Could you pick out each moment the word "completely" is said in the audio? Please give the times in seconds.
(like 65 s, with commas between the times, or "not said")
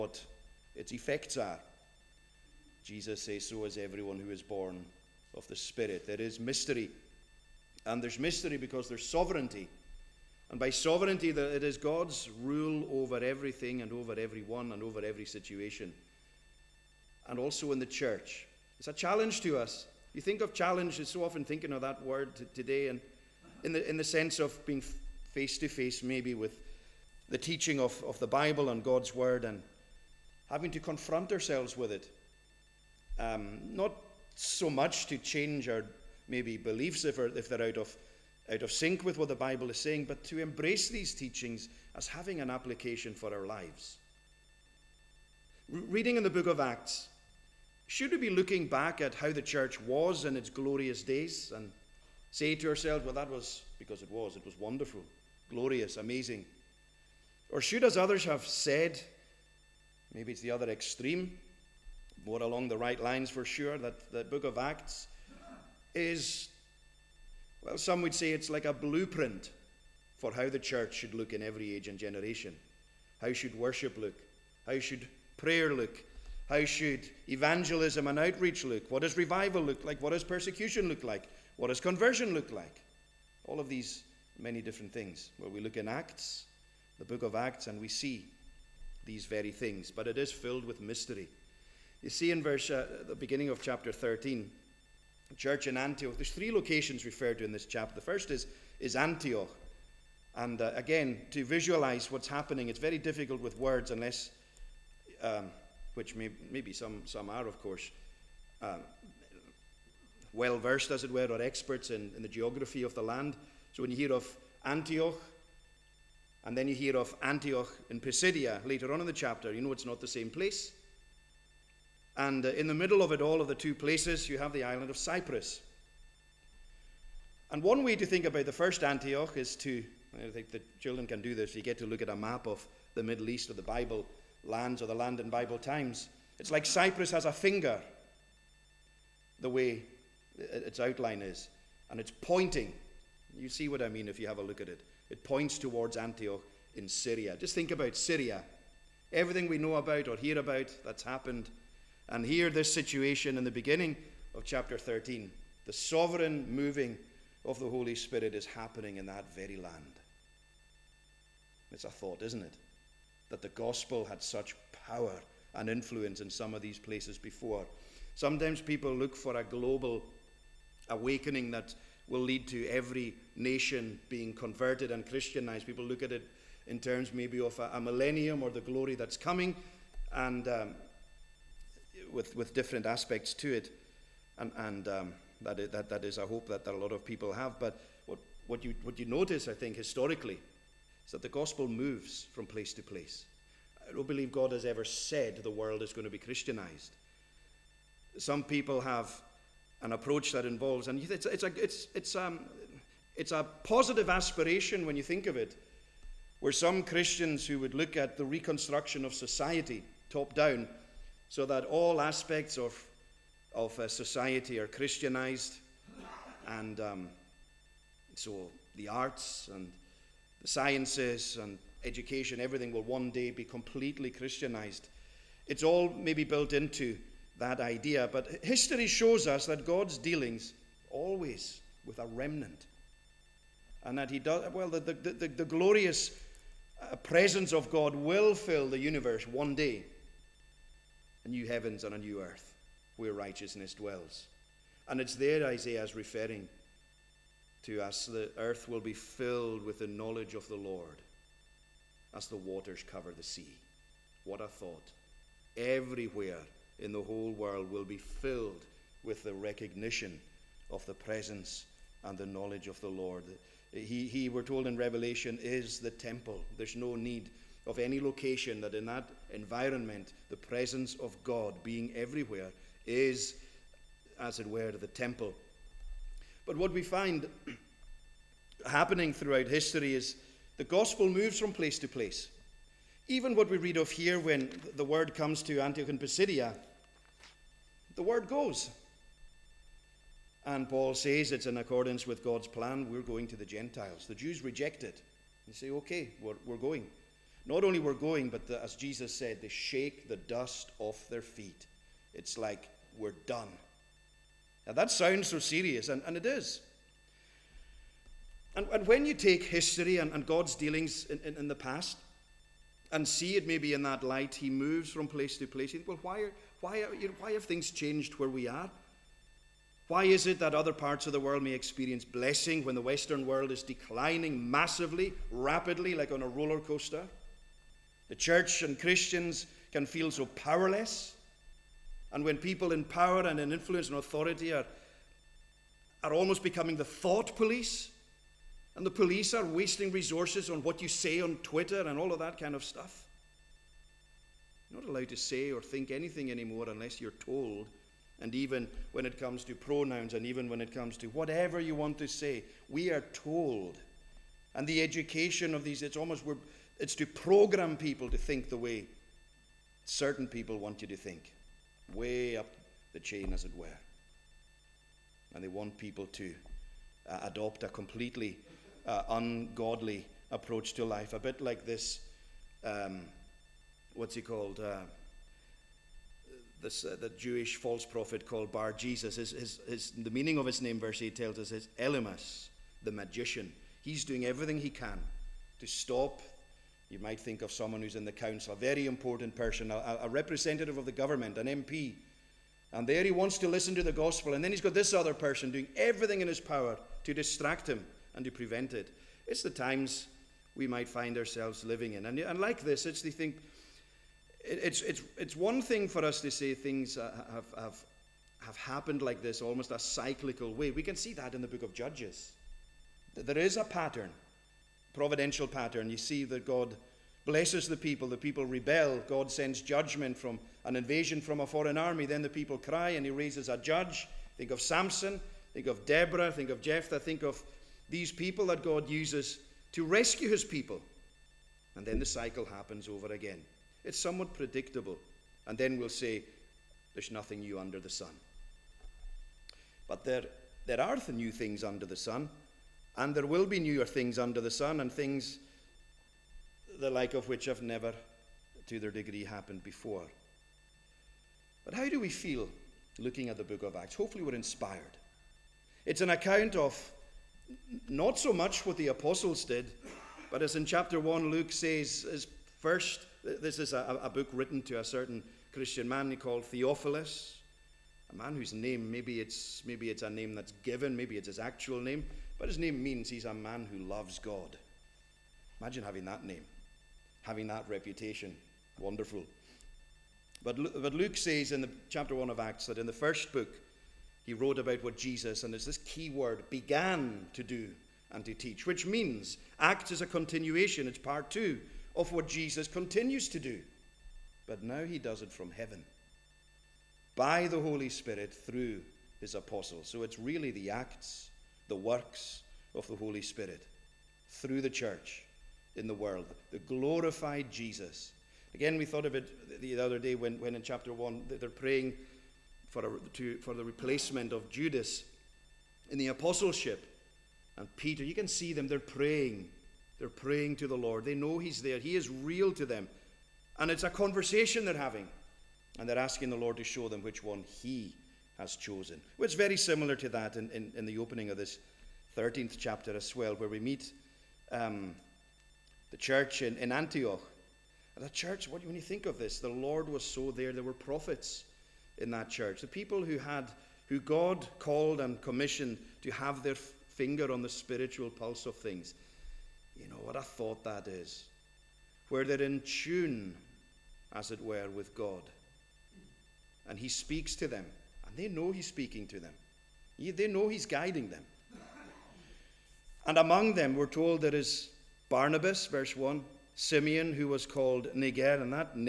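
223 s, 367 s.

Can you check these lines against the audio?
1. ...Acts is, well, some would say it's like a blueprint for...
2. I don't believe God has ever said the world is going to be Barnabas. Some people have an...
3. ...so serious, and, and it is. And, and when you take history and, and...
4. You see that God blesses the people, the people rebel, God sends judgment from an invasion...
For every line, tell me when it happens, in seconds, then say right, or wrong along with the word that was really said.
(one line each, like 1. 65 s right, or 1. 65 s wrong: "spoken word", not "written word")
1. 64 s right
2. 193 s wrong: "Christianized", not "Barnabas"
3. 305 s right
4. 415 s right.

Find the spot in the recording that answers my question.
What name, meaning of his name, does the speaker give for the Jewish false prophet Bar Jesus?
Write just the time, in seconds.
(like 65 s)
381 s.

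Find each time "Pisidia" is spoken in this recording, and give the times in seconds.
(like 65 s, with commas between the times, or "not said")
118 s, 285 s.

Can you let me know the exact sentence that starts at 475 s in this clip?
Imagine having that name, having that reputation.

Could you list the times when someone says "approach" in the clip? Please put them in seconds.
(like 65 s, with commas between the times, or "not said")
199 s, 370 s.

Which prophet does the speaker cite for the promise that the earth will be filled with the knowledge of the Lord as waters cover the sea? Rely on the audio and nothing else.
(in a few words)
Isaiah.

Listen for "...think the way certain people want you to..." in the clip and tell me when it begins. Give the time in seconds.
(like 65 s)
358 s.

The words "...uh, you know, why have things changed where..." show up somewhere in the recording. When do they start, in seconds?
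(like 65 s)
316 s.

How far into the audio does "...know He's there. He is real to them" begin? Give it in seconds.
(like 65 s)
521 s.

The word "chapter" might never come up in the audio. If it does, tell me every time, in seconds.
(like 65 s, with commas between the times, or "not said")
93 s, 97 s, 119 s, 154 s, 460 s, 481 s, 510 s, 532 s.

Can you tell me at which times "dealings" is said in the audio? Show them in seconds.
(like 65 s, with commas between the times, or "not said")
229 s, 310 s.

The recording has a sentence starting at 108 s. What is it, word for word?
Um, well versed, as it were, or experts in, in the geography of the land.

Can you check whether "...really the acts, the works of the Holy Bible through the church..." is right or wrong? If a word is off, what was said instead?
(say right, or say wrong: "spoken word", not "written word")
wrong: "Spirit", not "Bible".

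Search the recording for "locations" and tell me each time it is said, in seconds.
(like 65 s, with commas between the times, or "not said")
96 s, 267 s.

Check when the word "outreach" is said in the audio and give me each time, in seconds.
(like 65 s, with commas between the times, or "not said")
78 s.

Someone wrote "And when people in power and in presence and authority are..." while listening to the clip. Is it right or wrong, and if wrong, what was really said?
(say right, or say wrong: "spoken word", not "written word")
wrong: "influence", not "presence".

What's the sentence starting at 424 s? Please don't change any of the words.
Think of Samson, think of Deborah, think of Jephthah, think of these people that God uses to rescue his people.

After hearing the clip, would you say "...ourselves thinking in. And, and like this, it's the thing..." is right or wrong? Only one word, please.
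wrong.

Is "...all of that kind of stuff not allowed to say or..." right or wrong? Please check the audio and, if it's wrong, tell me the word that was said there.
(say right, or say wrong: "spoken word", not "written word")
right.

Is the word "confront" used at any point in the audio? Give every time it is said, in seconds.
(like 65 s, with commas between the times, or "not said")
30 s.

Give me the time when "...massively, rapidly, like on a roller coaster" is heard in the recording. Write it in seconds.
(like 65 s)
324 s.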